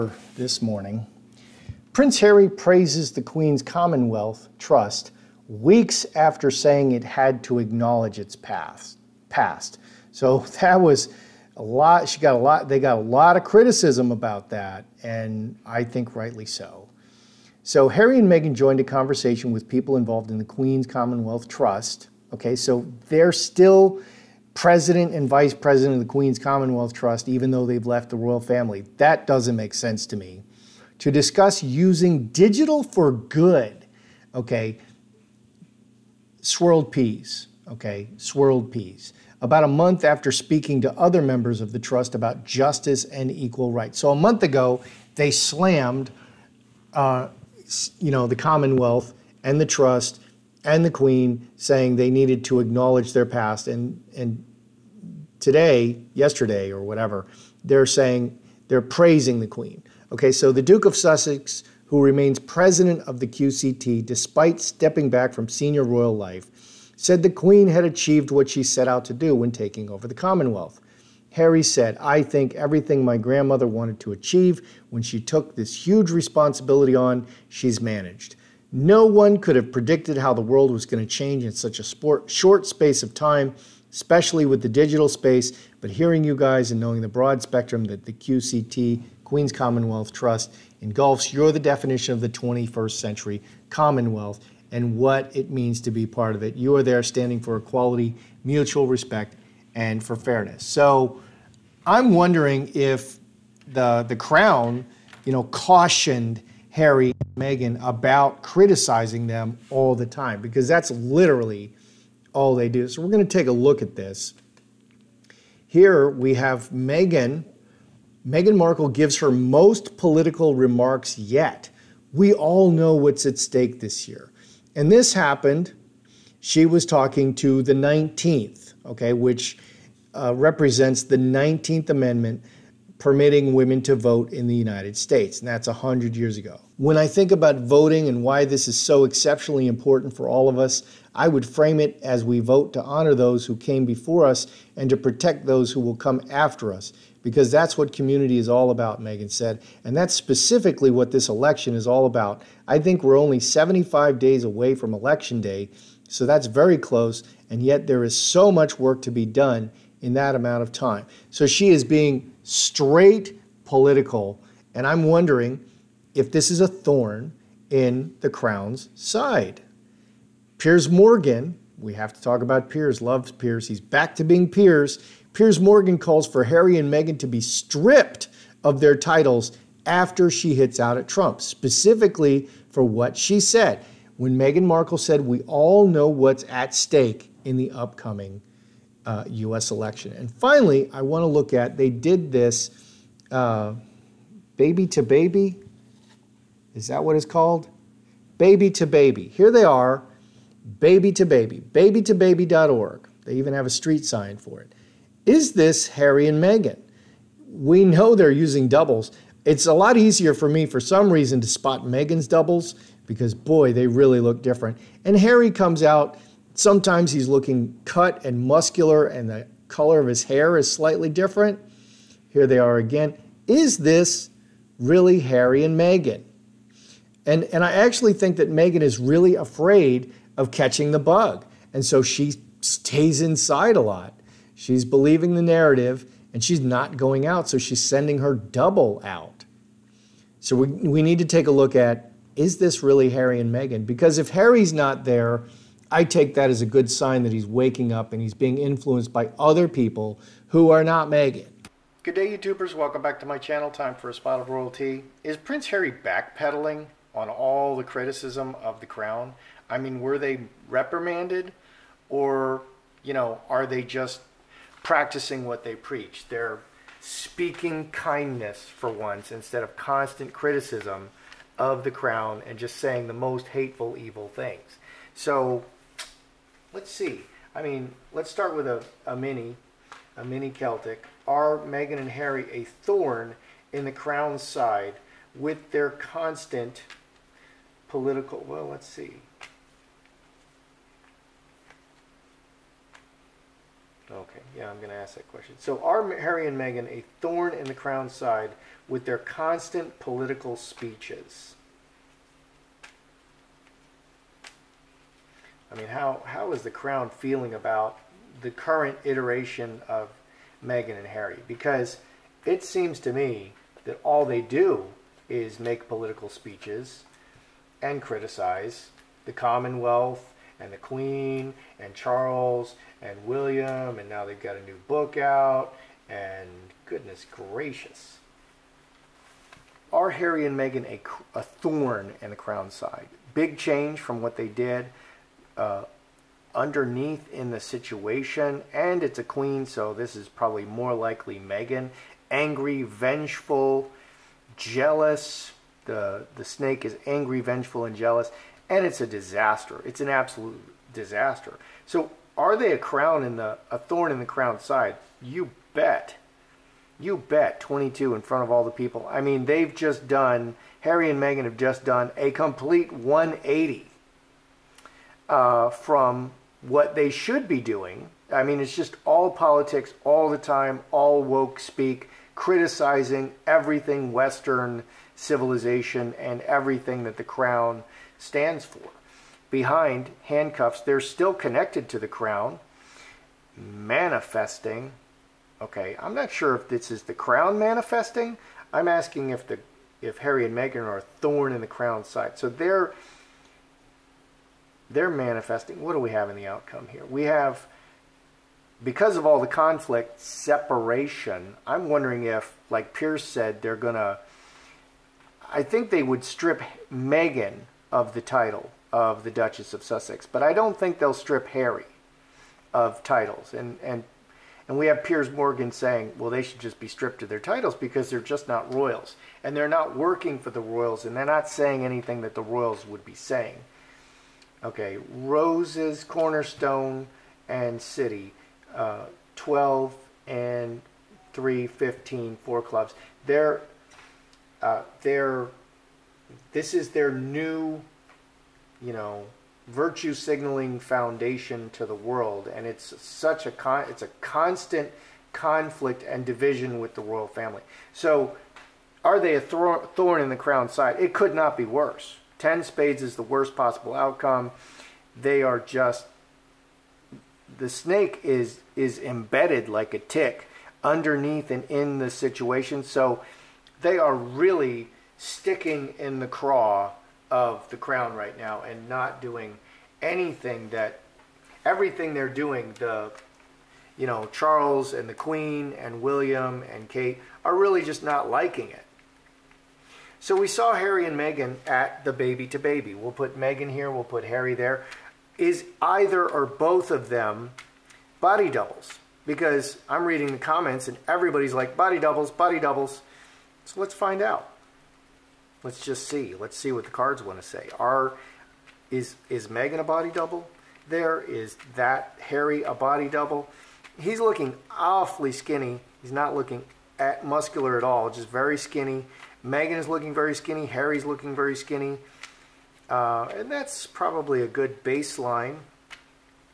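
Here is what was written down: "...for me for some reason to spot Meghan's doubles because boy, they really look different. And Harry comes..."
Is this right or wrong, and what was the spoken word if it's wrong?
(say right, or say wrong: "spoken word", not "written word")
right.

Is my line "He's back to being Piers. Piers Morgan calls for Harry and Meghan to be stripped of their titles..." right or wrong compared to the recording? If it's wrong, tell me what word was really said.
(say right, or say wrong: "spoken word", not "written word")
right.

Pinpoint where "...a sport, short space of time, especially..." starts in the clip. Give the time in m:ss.
1:21.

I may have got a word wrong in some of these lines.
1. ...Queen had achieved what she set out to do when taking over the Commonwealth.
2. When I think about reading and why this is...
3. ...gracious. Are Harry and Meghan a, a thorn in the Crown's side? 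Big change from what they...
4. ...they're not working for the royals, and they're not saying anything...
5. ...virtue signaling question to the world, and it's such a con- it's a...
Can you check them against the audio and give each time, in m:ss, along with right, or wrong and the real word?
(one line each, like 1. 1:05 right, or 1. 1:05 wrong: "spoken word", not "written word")
1. 1:07 right
2. 2:16 wrong: "voting", not "reading"
3. 5:27 right
4. 6:59 right
5. 7:19 wrong: "foundation", not "question".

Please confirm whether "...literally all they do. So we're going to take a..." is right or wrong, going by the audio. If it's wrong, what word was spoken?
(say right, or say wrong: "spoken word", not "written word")
right.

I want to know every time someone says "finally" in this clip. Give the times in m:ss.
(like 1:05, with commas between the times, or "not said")
3:10.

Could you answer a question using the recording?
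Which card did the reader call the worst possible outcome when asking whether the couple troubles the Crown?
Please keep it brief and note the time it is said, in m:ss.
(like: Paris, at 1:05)
10 of spades, at 7:32.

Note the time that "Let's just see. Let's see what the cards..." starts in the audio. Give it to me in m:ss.
8:15.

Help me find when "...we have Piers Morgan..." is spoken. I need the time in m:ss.
6:54.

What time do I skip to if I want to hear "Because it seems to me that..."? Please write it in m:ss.
5:11.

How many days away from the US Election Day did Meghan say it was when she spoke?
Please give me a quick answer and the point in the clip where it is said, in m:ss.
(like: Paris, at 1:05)
75, at 2:33.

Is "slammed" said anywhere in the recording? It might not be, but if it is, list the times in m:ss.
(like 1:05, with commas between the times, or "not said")
0:45.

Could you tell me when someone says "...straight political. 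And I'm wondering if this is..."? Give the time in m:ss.
2:42.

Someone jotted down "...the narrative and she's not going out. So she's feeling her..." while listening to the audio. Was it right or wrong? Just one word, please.
wrong.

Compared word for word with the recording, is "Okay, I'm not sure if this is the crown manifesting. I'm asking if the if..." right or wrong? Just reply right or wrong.
right.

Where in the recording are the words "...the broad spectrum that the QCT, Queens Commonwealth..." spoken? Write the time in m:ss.
1:27.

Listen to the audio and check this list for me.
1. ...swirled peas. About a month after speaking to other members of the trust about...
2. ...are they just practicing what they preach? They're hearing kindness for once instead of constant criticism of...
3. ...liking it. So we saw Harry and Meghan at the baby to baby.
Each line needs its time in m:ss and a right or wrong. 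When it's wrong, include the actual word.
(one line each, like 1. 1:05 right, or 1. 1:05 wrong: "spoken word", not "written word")
1. 0:38 right
2. 4:23 wrong: "speaking", not "hearing"
3. 7:58 right.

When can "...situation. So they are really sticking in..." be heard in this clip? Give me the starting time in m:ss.
7:42.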